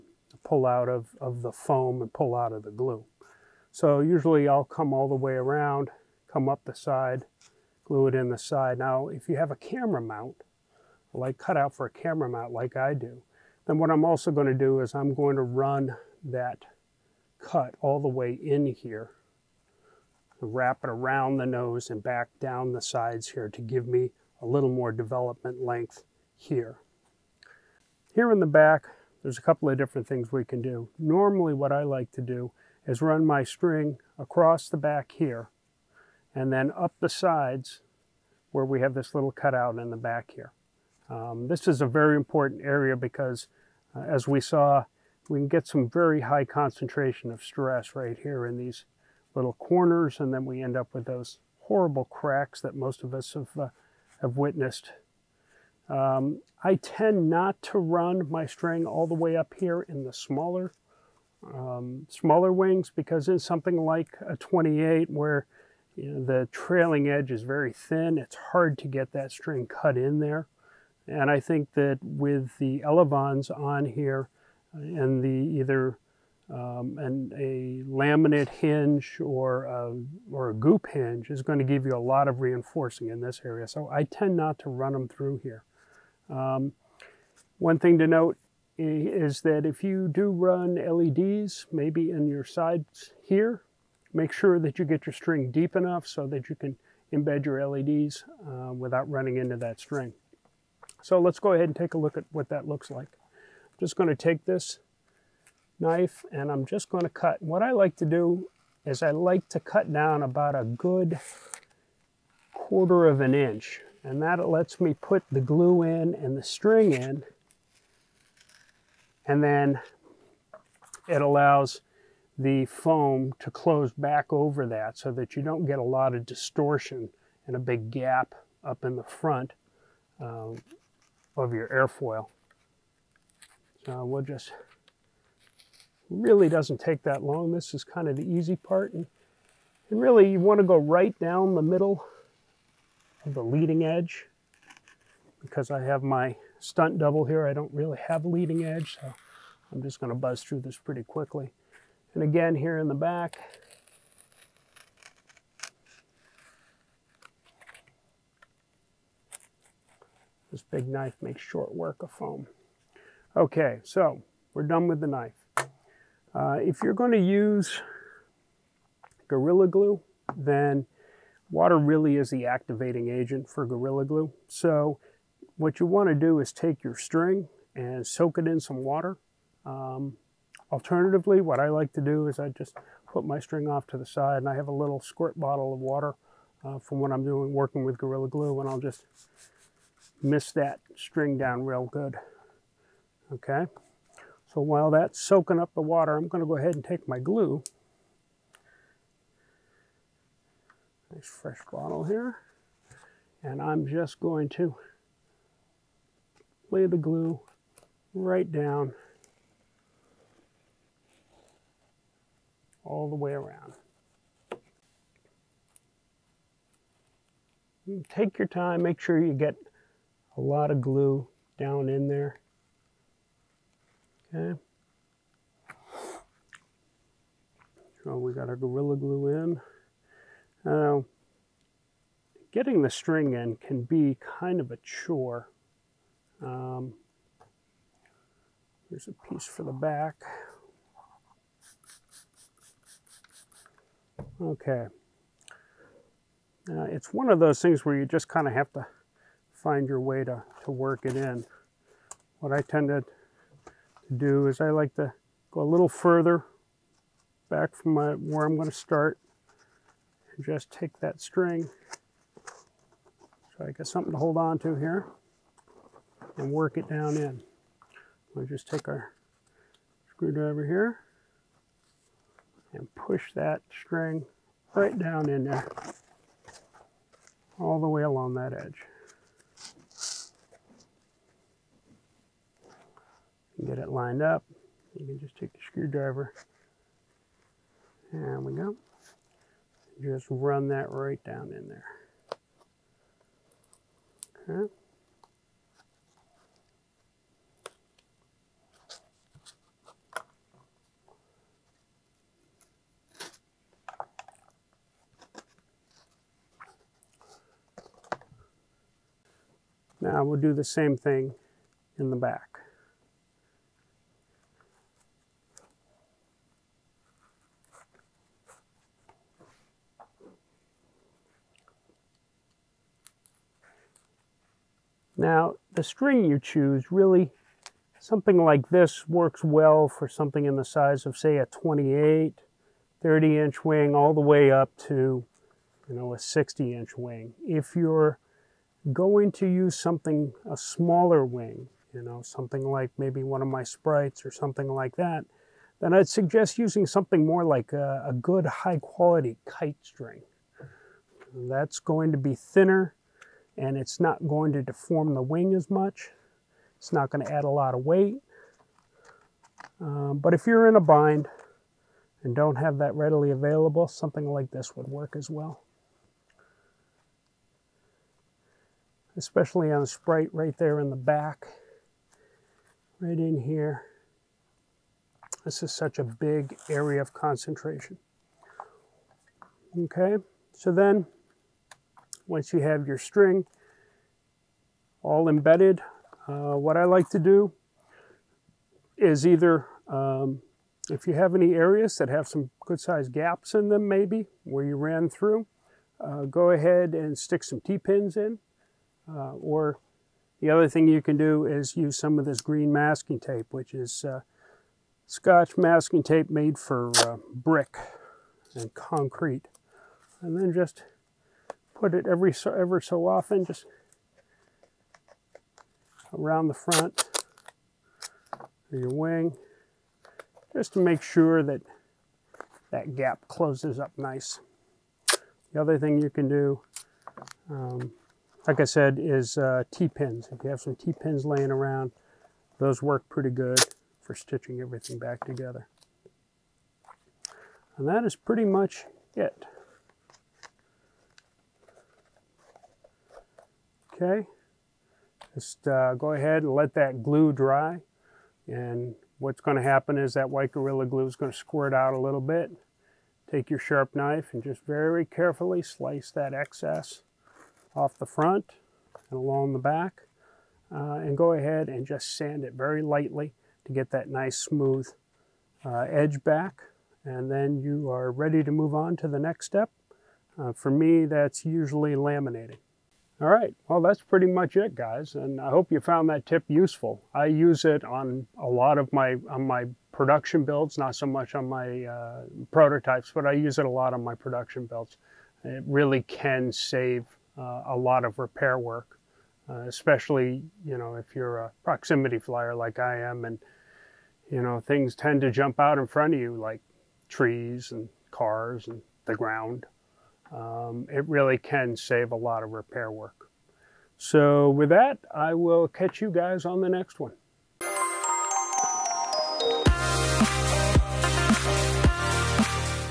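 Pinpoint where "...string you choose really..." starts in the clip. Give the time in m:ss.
5:25.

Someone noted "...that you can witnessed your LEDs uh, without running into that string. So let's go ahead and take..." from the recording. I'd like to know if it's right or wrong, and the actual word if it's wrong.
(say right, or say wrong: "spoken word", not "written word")
wrong: "embed", not "witnessed".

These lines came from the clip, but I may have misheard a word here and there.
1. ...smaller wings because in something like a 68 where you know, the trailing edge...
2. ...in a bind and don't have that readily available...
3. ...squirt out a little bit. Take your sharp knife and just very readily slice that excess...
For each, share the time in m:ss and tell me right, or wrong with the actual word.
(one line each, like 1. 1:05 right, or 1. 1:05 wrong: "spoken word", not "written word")
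1. 1:02 wrong: "28", not "68"
2. 6:00 right
3. 7:31 wrong: "carefully", not "readily".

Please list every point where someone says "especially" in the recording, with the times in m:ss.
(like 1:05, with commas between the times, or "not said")
6:09, 8:09.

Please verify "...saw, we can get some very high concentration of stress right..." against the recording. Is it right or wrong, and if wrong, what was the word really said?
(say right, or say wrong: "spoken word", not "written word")
right.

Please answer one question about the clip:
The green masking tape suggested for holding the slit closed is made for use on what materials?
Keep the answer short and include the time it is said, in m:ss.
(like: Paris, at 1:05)
brick and concrete, at 6:47.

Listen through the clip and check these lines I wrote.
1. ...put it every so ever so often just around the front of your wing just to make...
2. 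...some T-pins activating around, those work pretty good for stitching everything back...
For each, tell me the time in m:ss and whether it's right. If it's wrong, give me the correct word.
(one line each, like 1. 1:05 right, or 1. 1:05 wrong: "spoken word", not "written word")
1. 6:51 right
2. 7:10 wrong: "laying", not "activating".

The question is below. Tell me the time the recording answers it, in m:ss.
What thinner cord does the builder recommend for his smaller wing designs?
5:49.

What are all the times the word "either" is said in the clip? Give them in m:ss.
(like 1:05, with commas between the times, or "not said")
1:15, 6:29.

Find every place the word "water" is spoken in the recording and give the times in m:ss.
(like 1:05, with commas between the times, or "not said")
2:51, 2:58, 3:05, 3:15.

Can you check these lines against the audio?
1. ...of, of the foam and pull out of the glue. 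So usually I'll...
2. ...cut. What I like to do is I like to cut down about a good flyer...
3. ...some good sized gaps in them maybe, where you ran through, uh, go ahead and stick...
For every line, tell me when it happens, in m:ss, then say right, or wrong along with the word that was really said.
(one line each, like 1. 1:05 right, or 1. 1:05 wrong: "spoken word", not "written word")
1. 0:00 right
2. 1:47 wrong: "quarter", not "flyer"
3. 6:32 right.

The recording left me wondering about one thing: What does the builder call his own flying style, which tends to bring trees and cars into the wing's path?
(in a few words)
proximity flyer.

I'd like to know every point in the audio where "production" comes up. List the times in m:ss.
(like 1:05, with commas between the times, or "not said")
7:59, 8:04.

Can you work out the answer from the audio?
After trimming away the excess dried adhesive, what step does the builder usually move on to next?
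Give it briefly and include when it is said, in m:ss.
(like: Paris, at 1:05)
laminating, at 7:51.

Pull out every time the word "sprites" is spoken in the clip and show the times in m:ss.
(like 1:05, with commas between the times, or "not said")
5:43, 6:09.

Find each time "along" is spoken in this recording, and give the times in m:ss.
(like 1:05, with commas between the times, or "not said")
4:38, 7:39.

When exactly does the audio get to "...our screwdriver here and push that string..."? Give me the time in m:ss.
4:28.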